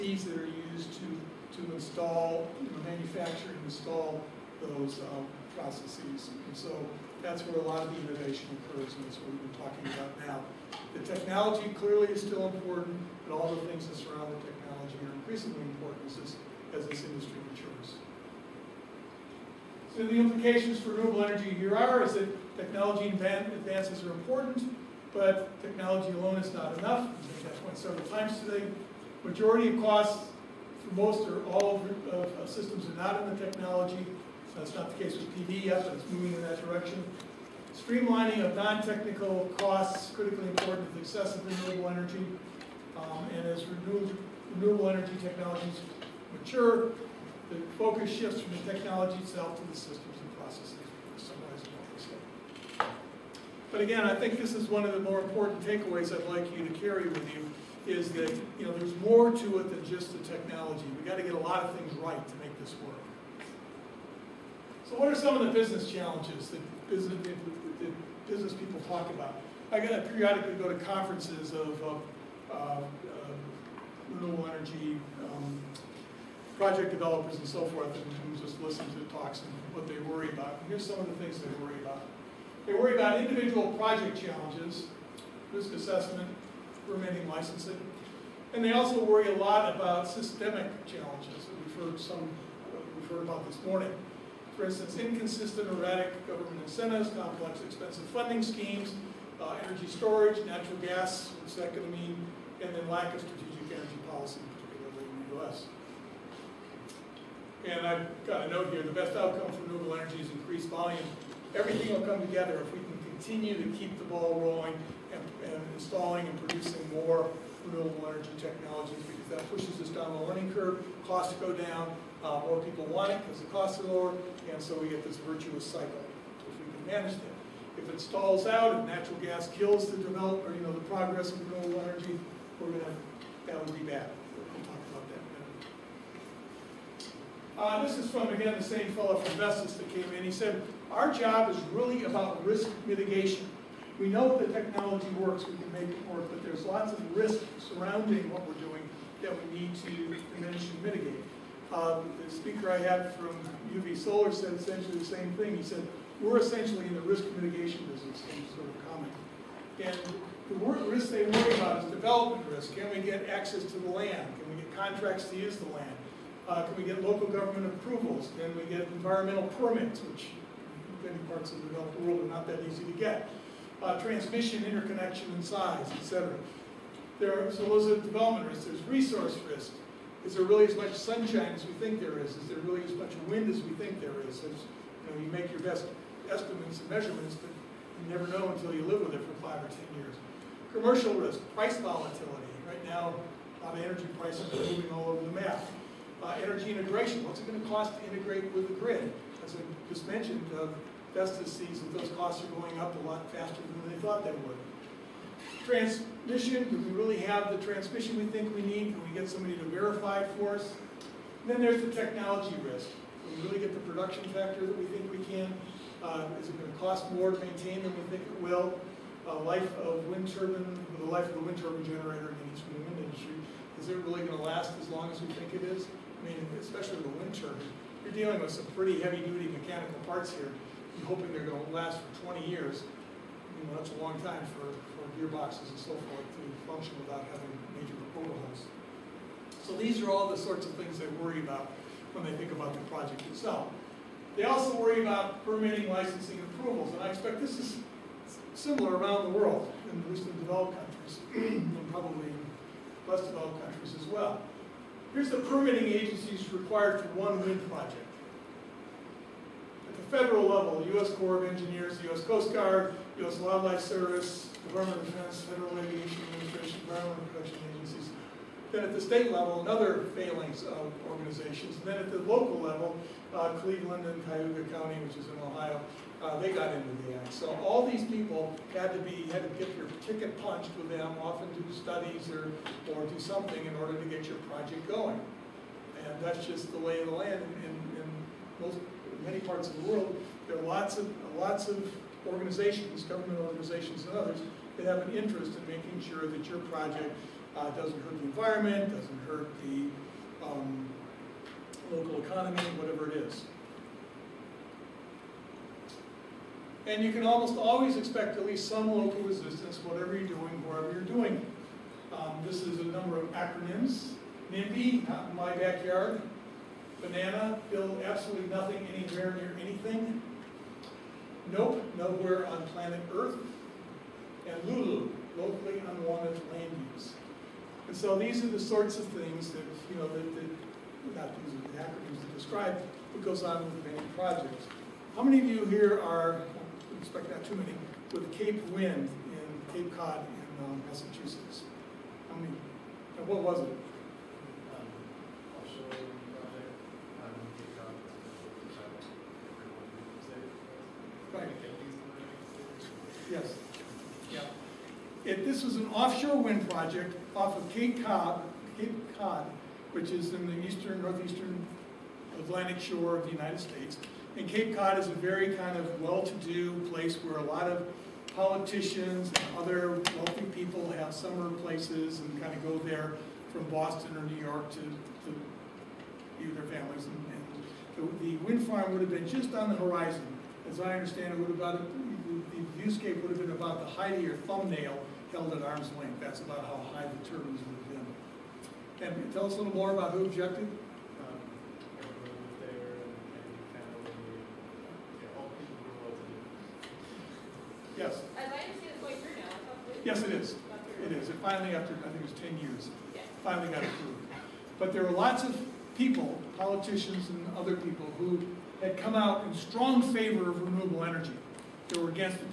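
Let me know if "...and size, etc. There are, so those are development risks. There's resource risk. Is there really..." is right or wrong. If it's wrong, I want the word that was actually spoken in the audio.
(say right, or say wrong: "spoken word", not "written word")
right.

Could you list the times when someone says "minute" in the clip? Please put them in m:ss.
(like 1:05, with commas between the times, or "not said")
not said.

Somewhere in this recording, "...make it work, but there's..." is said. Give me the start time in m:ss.
2:25.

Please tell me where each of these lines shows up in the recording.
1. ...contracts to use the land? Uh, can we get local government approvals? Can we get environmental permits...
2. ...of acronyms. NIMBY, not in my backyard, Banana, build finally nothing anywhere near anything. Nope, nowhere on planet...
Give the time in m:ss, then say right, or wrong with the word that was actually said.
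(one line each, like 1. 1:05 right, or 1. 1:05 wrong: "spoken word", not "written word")
1. 2:44 right
2. 5:13 wrong: "absolutely", not "finally".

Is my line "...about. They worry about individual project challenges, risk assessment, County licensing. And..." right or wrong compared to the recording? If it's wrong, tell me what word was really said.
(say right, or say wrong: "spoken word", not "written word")
wrong: "Permitting", not "County".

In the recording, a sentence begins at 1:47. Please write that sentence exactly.
And I've got a note here, the best outcome for renewable energy is increased volume.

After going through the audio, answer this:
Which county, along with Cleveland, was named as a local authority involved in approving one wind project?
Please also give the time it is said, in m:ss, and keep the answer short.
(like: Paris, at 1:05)
Cuyahoga County, at 4:34.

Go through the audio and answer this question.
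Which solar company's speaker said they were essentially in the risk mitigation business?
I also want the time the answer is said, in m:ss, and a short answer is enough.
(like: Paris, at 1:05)
UV Solar, at 2:33.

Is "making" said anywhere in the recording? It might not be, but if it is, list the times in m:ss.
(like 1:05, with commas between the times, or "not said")
4:55.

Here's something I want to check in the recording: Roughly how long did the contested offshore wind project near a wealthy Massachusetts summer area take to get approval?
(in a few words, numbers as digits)
10 years.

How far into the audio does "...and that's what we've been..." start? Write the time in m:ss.
0:08.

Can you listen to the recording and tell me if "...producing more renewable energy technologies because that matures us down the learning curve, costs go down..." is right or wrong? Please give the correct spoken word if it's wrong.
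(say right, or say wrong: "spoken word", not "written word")
wrong: "pushes", not "matures".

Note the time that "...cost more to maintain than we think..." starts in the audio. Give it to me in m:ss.
3:36.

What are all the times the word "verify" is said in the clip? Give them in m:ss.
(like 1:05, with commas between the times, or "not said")
3:29.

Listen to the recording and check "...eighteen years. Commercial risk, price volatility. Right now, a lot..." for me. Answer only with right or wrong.
wrong.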